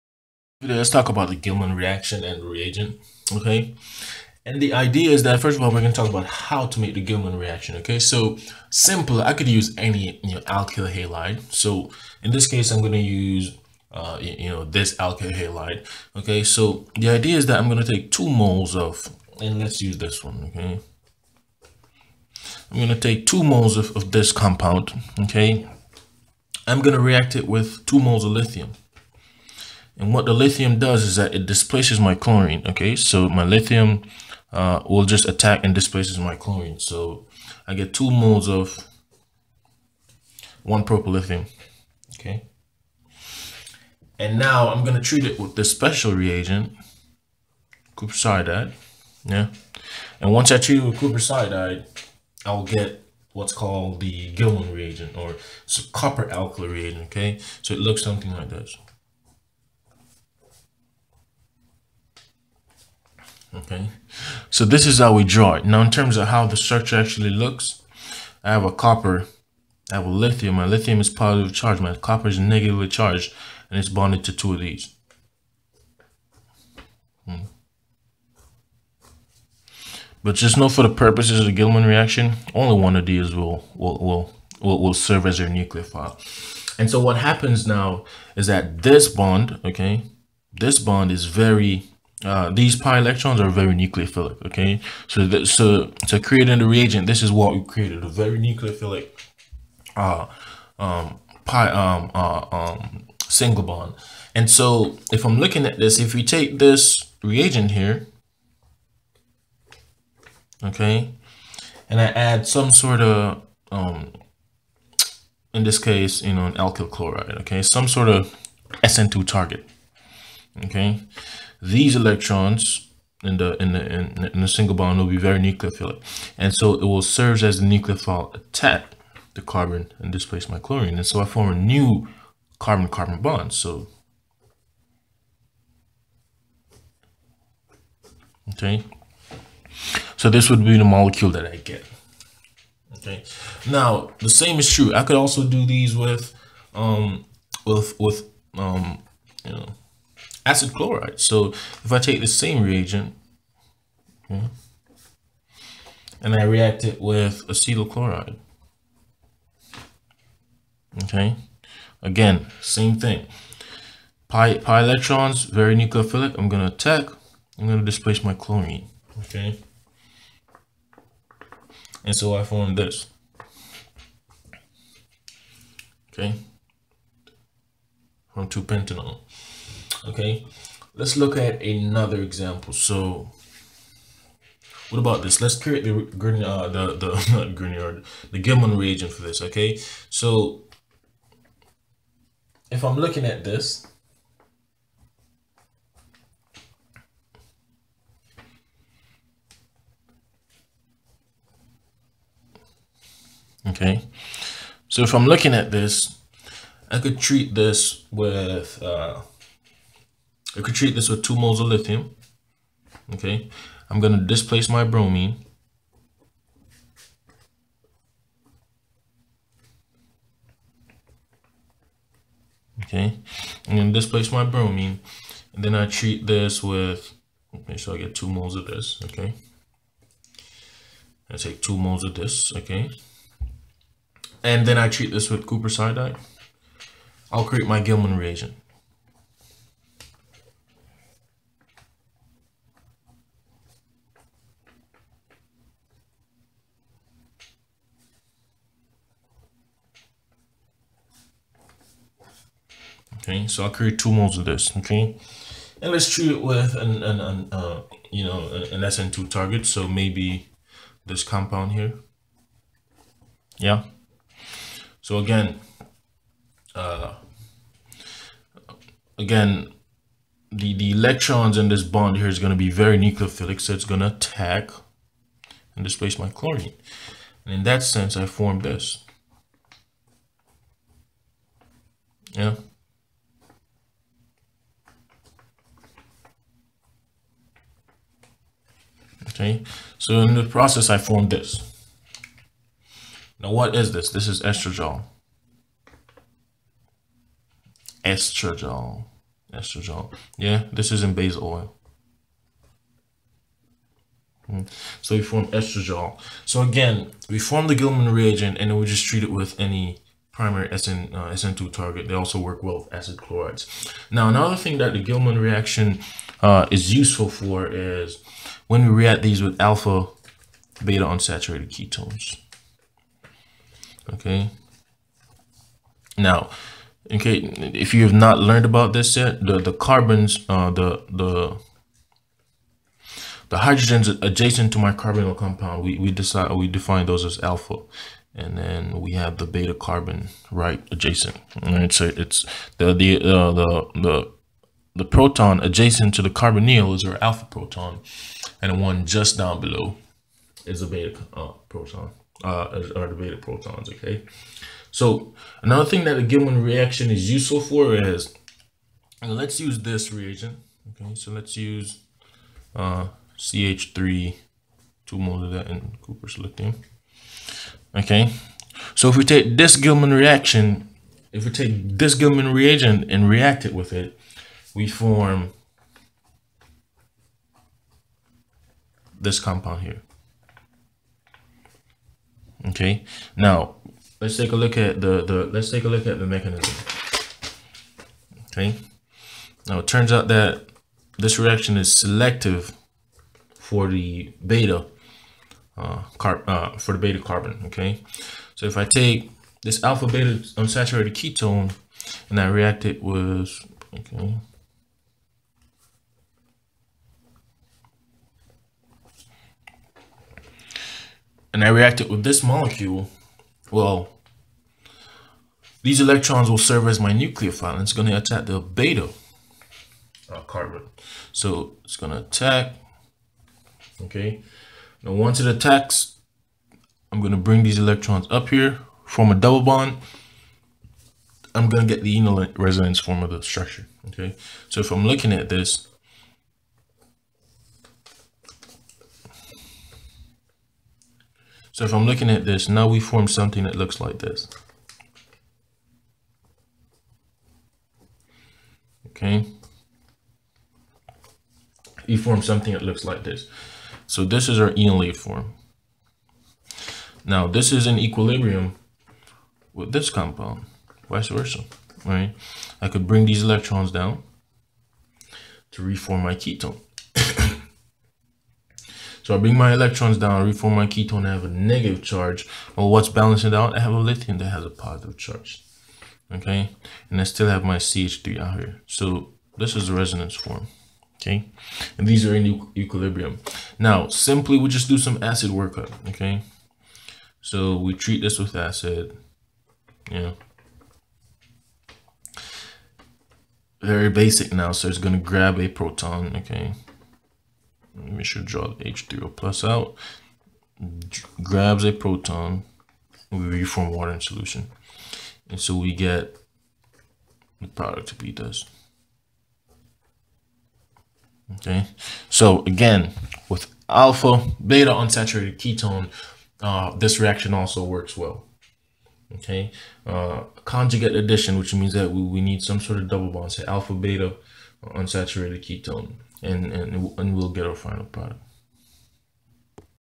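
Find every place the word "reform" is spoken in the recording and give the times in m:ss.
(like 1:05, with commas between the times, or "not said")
7:45, 7:50, 8:23.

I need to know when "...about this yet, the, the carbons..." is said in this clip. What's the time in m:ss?
5:28.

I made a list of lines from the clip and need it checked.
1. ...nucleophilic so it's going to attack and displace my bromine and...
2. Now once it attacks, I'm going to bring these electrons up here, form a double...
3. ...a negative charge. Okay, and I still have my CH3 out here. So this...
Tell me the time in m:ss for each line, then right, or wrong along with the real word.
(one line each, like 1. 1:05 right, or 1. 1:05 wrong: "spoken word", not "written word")
1. 4:32 wrong: "chlorine", not "bromine"
2. 7:05 right
3. 7:54 wrong: "positive", not "negative".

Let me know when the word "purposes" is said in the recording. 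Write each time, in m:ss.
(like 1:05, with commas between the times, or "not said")
1:20.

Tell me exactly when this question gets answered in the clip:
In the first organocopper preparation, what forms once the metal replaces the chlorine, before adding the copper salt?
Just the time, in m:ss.
0:40.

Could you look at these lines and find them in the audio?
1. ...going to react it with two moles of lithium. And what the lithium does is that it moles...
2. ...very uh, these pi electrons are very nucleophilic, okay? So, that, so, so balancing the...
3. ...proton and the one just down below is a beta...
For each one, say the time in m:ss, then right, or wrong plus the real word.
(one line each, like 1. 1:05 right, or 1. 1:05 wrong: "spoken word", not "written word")
1. 0:26 wrong: "displaces", not "moles"
2. 1:31 wrong: "creating", not "balancing"
3. 5:47 right.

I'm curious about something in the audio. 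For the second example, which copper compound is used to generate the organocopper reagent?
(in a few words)
Copper iodide.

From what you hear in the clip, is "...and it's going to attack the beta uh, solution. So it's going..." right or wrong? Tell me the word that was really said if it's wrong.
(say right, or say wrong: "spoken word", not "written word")
wrong: "carbon", not "solution".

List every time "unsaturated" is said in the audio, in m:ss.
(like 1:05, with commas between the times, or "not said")
5:21, 6:40, 8:34, 8:44.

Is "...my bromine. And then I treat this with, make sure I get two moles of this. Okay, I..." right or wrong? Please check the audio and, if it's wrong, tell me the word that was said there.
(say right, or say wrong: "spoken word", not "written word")
right.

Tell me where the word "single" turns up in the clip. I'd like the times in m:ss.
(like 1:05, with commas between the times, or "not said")
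1:43, 2:04.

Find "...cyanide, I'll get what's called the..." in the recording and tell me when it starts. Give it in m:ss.
0:51.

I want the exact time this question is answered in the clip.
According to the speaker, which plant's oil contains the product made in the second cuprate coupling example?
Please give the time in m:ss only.
5:01.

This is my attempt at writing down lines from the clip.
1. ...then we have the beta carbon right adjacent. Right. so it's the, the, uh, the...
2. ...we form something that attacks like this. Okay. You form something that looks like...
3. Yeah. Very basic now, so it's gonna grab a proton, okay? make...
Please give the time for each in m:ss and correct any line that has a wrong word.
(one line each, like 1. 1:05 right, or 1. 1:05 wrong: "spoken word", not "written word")
1. 5:38 right
2. 7:22 wrong: "looks", not "attacks"
3. 8:10 right.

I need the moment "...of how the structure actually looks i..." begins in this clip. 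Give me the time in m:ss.
1:06.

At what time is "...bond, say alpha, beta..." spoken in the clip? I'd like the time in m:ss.
8:43.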